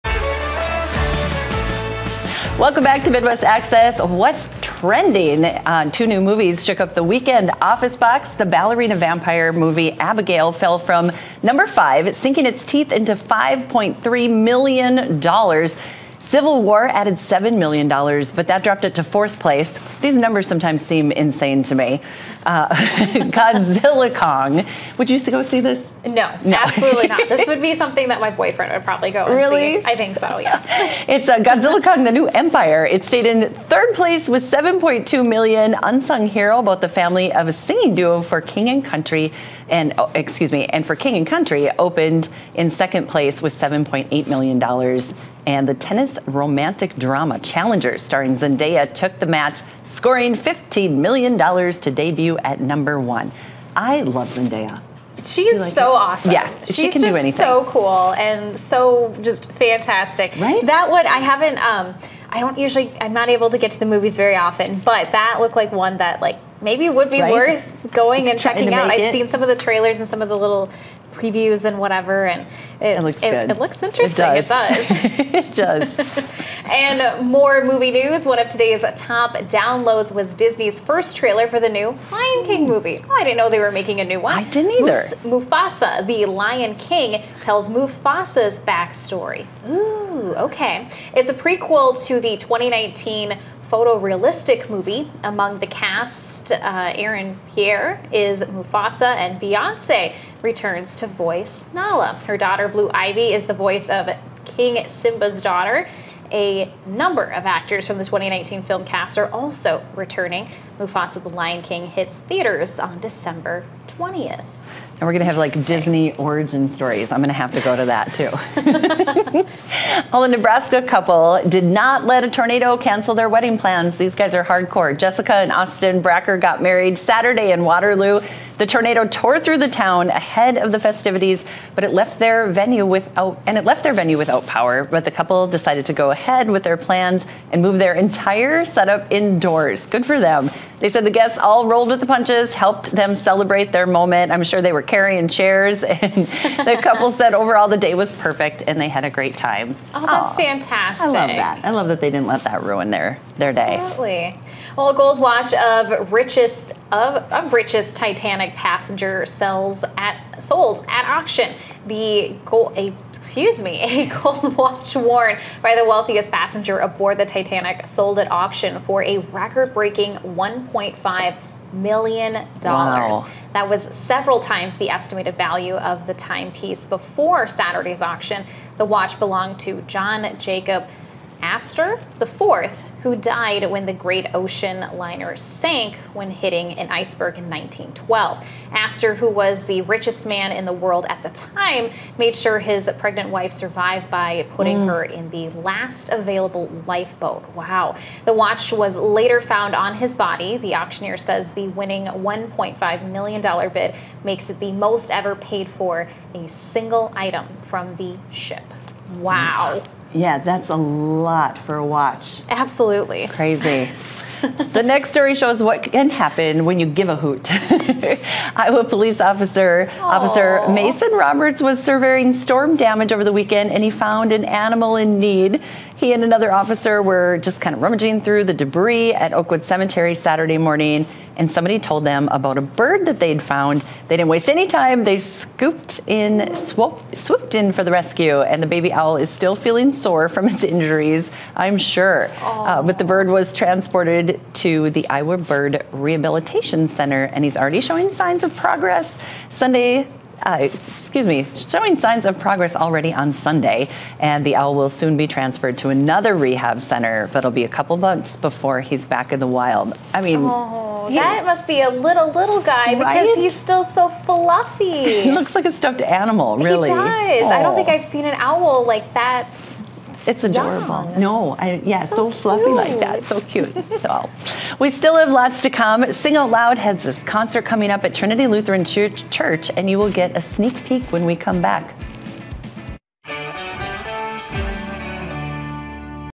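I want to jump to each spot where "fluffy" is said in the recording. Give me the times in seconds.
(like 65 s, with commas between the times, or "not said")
264 s, 272 s.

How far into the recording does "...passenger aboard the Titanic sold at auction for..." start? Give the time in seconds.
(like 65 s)
166 s.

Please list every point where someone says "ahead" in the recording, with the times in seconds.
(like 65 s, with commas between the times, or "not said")
130 s, 136 s.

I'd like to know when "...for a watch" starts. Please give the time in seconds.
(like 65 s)
211 s.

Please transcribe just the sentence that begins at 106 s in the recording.
A number of actors from the 2019 film cast are also returning.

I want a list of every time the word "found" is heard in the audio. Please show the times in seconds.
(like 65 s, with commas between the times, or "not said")
199 s, 223 s, 233 s.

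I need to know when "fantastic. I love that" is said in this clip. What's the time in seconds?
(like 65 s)
150 s.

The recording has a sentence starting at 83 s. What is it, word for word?
Oh, I didn't know they were making a new one.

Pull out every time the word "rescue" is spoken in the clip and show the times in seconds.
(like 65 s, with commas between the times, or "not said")
237 s.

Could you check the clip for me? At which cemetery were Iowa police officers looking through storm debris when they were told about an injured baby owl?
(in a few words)
Oakwood Cemetery.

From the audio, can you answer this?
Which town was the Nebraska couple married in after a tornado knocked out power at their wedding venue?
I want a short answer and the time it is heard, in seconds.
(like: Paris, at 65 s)
Waterloo, at 127 s.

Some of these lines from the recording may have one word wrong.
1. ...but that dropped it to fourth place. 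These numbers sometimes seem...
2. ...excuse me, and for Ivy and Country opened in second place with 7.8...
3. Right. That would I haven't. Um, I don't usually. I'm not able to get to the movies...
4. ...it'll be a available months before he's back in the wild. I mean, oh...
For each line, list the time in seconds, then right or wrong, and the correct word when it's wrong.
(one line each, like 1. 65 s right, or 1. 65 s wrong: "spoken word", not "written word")
1. 17 s right
2. 40 s wrong: "King", not "Ivy"
3. 60 s right
4. 257 s wrong: "couple", not "available".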